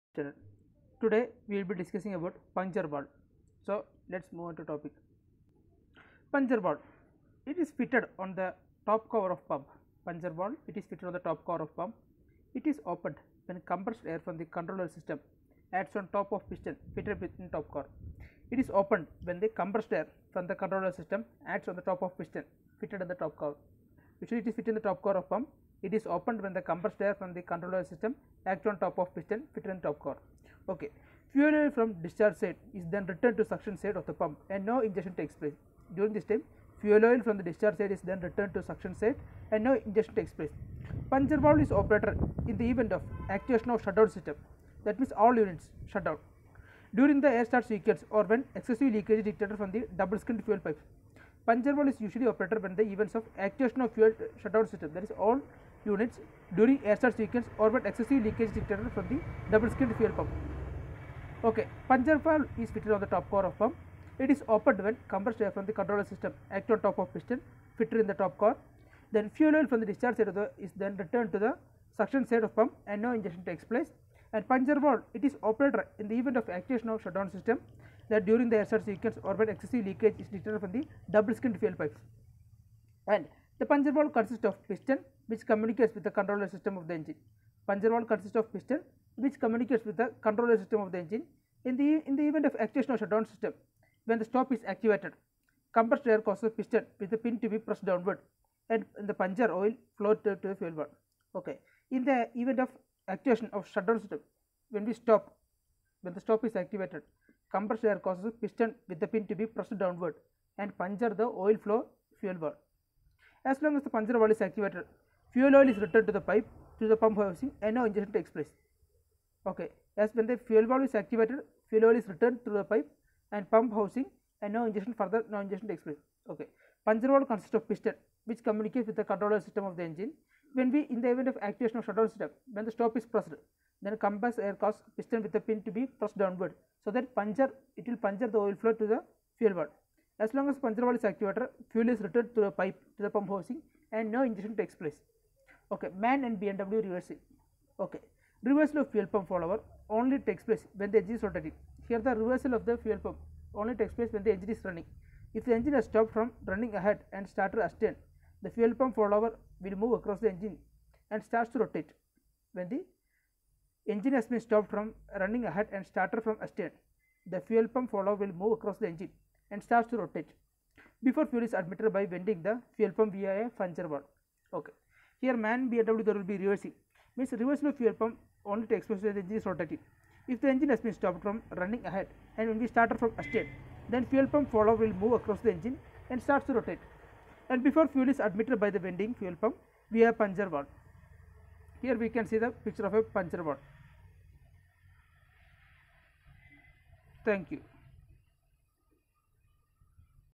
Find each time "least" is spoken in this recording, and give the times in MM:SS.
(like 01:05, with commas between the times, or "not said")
not said.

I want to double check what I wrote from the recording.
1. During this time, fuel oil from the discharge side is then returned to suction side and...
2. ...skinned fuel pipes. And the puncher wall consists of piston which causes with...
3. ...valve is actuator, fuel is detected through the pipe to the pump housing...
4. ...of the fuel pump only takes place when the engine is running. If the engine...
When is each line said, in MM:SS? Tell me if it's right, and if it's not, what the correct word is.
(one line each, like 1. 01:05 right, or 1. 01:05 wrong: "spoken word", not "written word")
1. 00:35 right
2. 01:21 wrong: "communicates", not "causes"
3. 02:20 wrong: "returned", not "detected"
4. 02:32 right.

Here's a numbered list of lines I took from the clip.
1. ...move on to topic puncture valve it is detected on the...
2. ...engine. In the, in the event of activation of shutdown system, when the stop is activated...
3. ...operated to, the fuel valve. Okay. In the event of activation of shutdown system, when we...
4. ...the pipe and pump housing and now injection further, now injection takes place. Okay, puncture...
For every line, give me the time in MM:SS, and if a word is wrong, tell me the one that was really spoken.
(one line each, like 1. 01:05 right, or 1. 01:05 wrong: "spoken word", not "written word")
1. 00:04 wrong: "fitted", not "detected"
2. 01:30 right
3. 01:39 wrong: "flowed", not "operated"
4. 02:02 right.